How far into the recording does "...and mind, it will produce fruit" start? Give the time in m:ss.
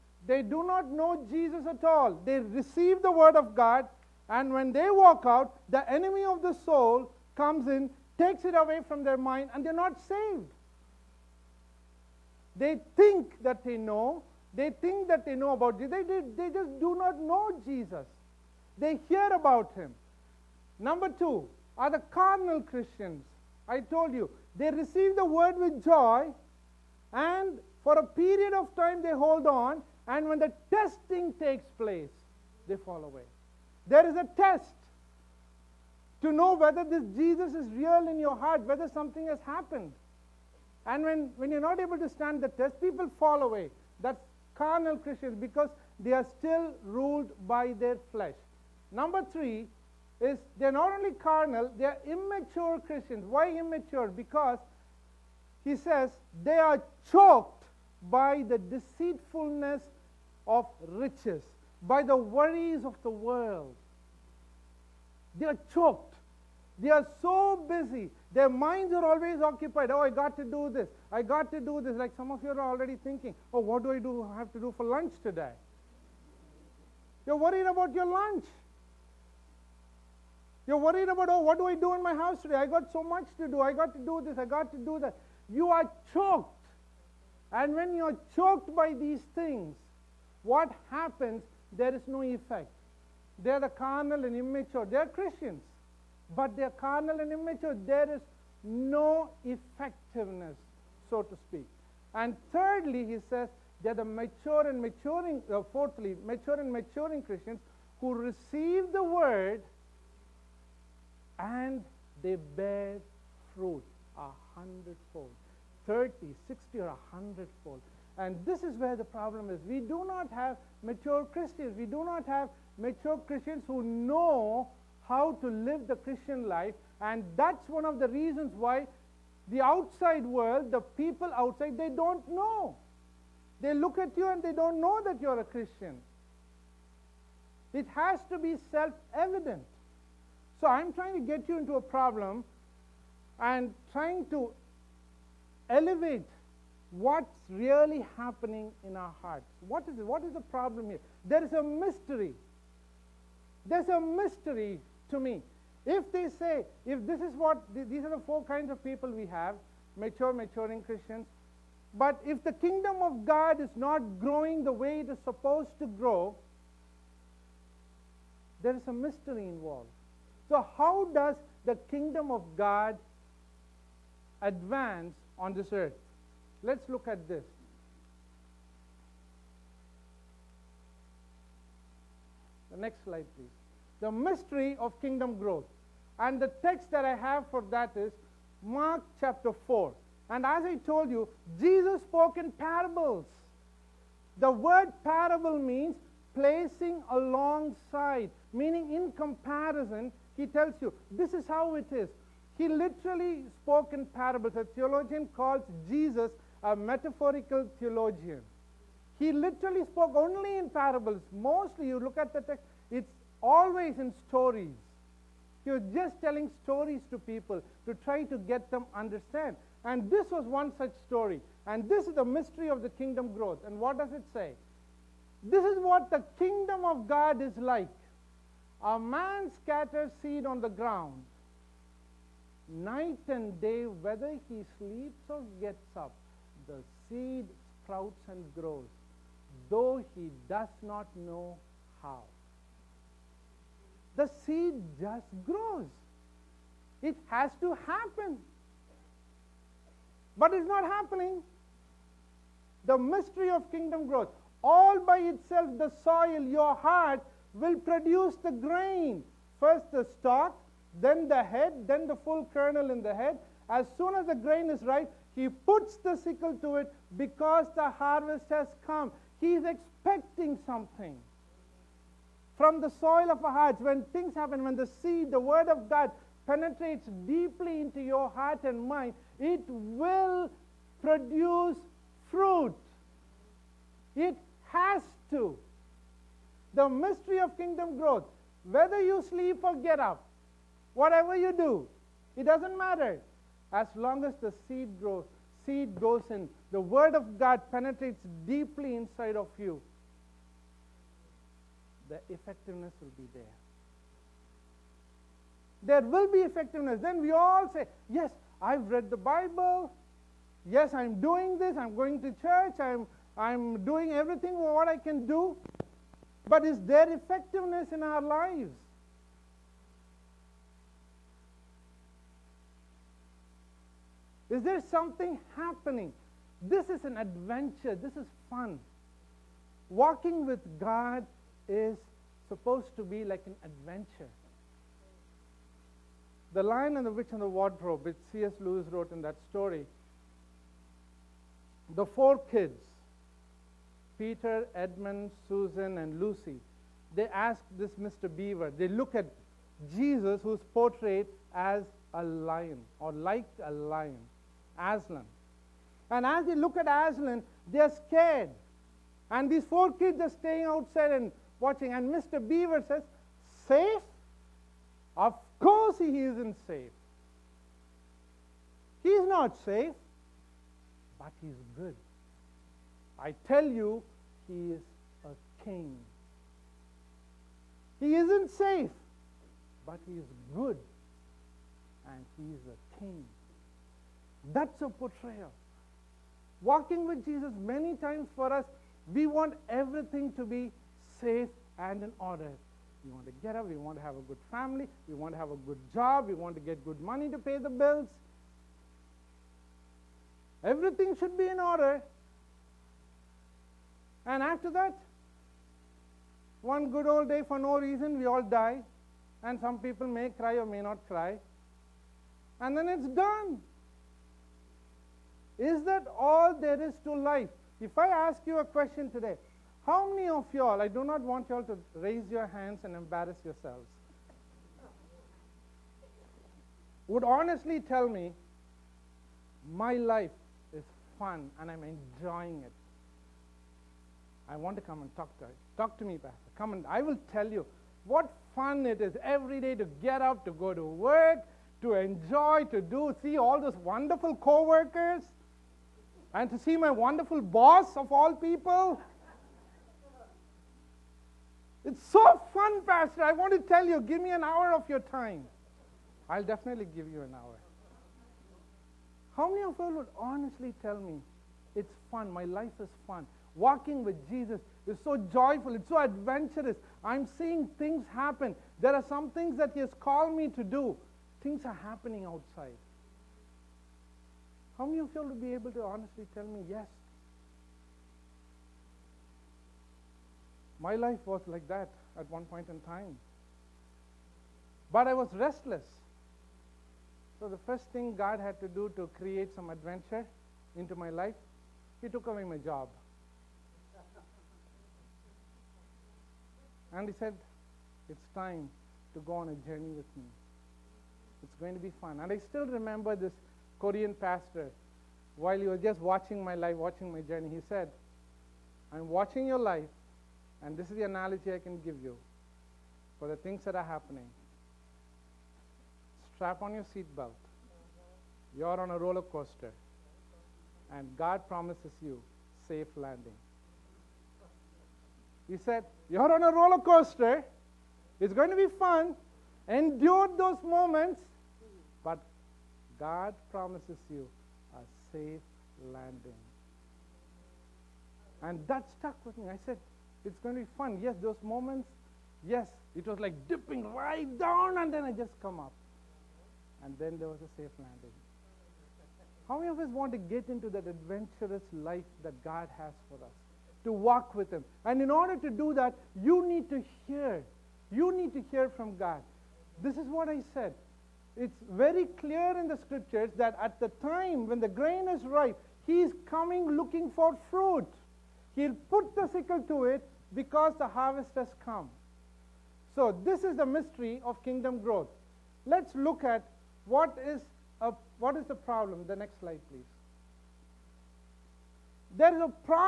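4:38.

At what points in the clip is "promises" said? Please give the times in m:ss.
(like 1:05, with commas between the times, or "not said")
8:41, 8:53.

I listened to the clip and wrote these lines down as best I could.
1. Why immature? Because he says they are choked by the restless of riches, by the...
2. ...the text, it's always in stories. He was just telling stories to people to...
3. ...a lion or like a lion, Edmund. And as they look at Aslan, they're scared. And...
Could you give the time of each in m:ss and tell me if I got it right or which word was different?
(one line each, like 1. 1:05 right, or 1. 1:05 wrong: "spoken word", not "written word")
1. 0:53 wrong: "deceitfulness", not "restless"
2. 3:32 right
3. 5:52 wrong: "Aslan", not "Edmund".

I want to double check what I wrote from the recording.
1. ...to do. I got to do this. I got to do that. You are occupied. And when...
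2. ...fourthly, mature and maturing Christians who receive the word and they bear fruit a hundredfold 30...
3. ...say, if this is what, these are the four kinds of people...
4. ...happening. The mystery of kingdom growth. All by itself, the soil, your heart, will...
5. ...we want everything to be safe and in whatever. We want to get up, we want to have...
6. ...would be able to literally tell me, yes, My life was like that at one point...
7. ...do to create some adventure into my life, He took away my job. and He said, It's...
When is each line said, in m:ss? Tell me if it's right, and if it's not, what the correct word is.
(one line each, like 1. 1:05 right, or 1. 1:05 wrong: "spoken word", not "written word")
1. 1:23 wrong: "choked", not "occupied"
2. 1:45 right
3. 2:36 right
4. 4:10 right
5. 6:29 wrong: "order", not "whatever"
6. 7:55 wrong: "honestly", not "literally"
7. 8:08 right.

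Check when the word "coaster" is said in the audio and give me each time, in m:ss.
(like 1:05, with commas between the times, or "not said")
8:39, 8:46.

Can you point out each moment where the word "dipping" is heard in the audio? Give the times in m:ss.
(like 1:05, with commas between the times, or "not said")
9:03.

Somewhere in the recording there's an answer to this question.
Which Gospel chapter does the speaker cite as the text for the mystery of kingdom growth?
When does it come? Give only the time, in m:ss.
3:08.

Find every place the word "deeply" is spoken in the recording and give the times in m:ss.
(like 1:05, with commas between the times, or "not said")
4:37, 4:58.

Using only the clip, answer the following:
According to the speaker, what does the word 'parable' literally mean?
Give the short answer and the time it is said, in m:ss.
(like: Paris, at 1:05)
placing alongside, at 3:16.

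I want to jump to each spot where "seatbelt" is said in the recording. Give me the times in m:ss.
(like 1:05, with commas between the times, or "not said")
8:36.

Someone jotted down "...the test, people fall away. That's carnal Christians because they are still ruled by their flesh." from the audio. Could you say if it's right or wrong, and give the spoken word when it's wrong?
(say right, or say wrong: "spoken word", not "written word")
right.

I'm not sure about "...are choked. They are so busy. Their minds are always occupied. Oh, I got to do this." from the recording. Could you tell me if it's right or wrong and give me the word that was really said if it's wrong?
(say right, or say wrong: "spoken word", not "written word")
right.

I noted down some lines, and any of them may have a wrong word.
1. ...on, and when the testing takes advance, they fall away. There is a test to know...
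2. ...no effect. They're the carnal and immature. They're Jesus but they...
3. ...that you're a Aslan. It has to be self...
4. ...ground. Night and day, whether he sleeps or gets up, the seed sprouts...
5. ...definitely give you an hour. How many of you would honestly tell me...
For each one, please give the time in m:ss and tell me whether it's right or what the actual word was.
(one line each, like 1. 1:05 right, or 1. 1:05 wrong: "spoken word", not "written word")
1. 0:29 wrong: "place", not "advance"
2. 1:32 wrong: "Christians", not "Jesus"
3. 2:15 wrong: "Christian", not "Aslan"
4. 3:50 right
5. 7:36 right.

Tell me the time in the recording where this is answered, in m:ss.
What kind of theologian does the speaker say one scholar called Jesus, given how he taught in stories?
3:26.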